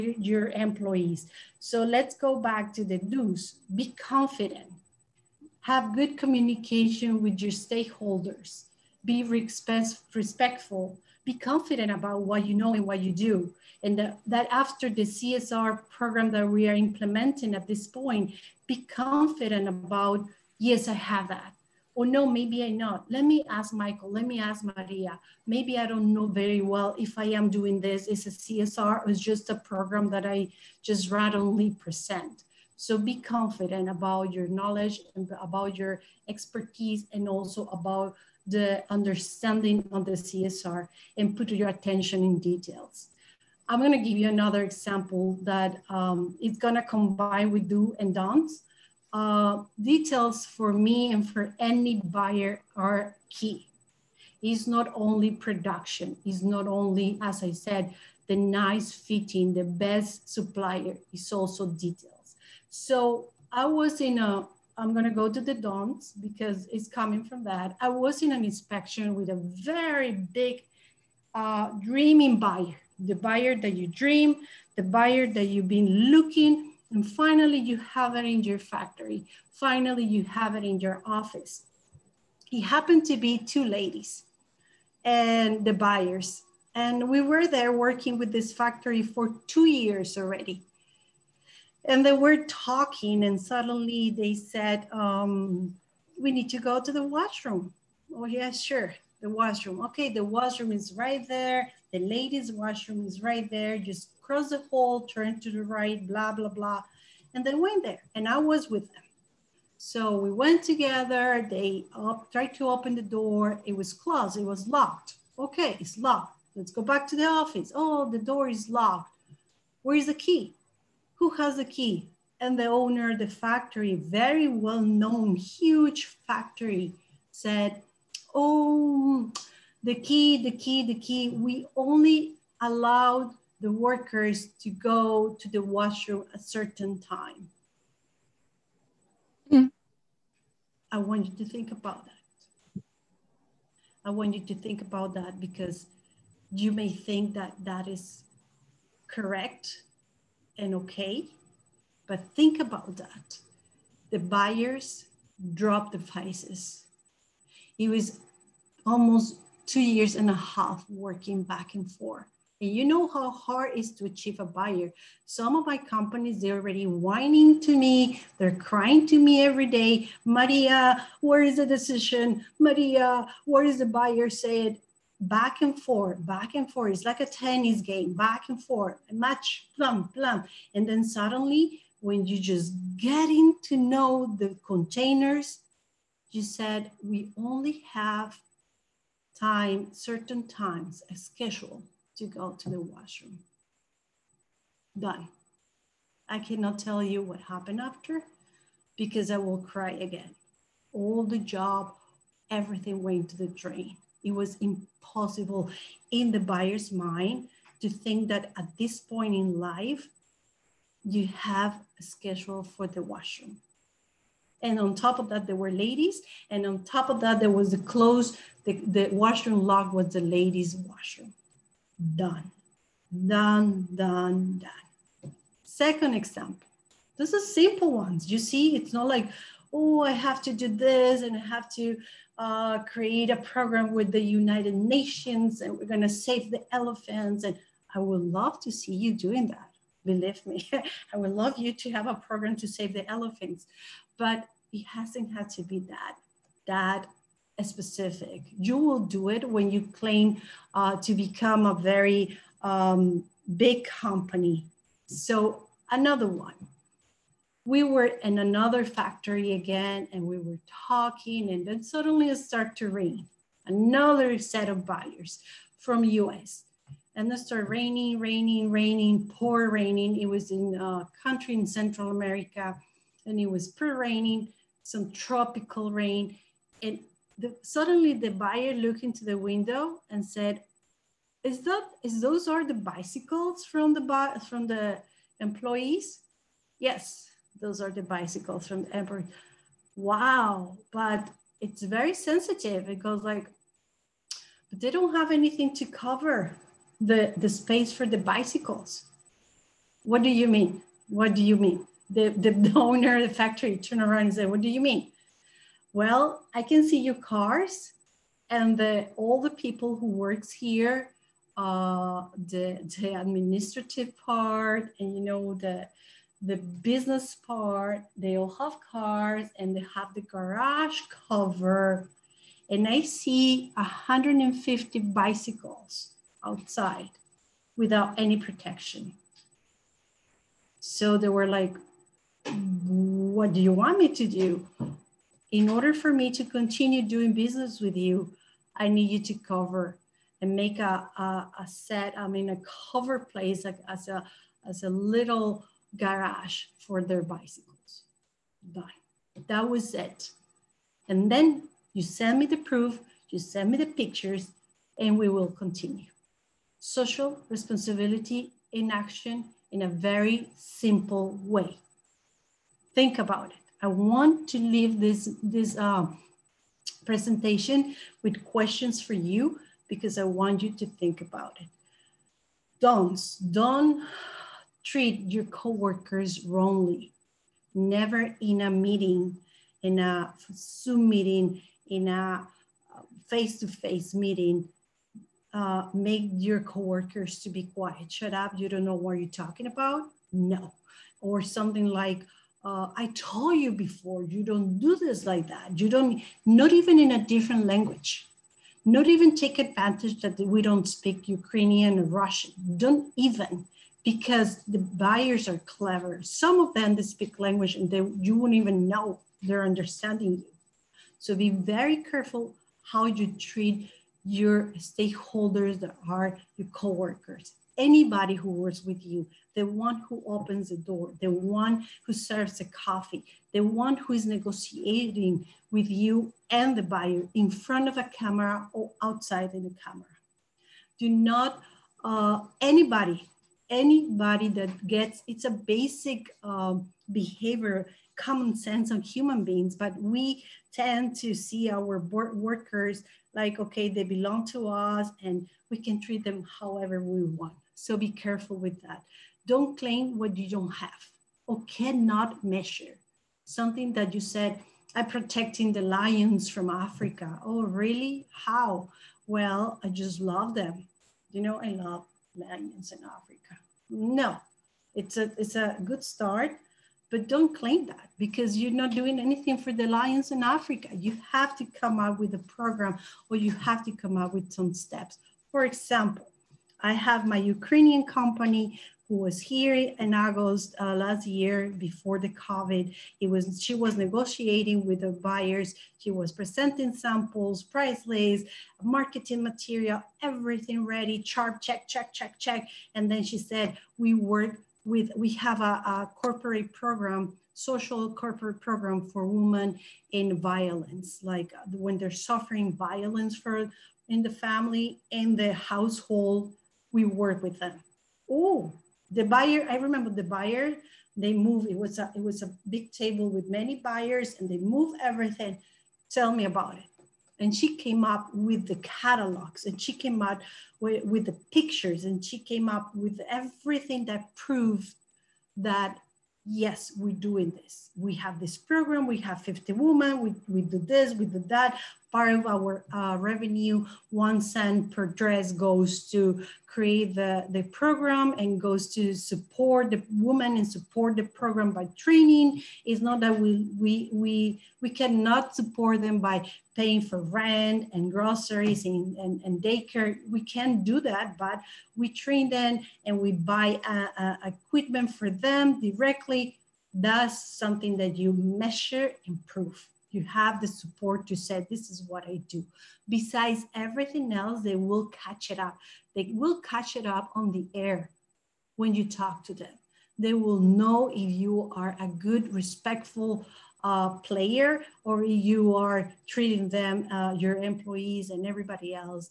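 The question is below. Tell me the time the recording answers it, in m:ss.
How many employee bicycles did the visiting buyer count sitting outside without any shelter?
5:23.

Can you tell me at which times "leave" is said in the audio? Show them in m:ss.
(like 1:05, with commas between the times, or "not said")
6:04.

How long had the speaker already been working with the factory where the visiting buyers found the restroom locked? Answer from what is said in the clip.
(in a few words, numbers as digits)
2 years.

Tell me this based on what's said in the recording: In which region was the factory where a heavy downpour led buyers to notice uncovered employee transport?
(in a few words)
Central America.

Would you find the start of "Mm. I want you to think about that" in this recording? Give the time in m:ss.
2:19.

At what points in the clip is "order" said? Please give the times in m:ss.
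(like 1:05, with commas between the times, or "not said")
5:35.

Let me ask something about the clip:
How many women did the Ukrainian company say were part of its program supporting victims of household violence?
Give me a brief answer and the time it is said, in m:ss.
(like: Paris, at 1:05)
50, at 8:49.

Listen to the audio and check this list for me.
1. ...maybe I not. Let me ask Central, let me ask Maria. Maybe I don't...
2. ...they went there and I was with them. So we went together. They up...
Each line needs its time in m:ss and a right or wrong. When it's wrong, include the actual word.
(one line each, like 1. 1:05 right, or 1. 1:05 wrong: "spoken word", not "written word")
1. 0:22 wrong: "Michael", not "Central"
2. 1:47 right.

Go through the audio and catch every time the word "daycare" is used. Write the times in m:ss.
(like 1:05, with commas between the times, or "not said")
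9:09.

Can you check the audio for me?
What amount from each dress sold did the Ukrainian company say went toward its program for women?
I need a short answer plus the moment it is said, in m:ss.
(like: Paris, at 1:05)
1 cent, at 8:54.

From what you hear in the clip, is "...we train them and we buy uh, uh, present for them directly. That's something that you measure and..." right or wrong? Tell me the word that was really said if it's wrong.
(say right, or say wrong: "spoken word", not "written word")
wrong: "equipment", not "present".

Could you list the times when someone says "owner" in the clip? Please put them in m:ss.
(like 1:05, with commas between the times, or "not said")
2:02, 5:02.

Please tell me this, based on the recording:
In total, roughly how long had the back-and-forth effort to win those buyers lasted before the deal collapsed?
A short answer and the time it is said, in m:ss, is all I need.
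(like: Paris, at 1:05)
2 and a half years, at 2:39.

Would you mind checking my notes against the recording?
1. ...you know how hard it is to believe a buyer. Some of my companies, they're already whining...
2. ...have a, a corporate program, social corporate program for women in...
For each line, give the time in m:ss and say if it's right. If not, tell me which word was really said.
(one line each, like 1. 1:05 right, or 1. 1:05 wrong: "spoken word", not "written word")
1. 2:42 wrong: "achieve", not "believe"
2. 8:15 right.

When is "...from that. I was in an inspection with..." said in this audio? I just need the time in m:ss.
1:07.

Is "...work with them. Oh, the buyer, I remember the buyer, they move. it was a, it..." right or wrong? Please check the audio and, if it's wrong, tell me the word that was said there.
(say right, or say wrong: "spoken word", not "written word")
right.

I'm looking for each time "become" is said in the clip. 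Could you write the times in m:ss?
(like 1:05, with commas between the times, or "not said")
4:11.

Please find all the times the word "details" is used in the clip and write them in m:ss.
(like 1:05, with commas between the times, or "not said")
0:42, 0:49, 1:01.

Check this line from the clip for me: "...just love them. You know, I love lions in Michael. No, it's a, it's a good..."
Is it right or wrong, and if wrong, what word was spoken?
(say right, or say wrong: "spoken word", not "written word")
wrong: "Africa", not "Michael".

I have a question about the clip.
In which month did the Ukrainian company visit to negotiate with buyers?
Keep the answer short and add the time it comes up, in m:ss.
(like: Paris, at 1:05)
August, at 8:00.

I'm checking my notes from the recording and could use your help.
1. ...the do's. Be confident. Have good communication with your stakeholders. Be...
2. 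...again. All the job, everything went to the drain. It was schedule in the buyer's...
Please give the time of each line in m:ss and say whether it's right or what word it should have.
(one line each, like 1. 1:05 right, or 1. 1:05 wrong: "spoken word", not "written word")
1. 0:02 right
2. 3:19 wrong: "impossible", not "schedule".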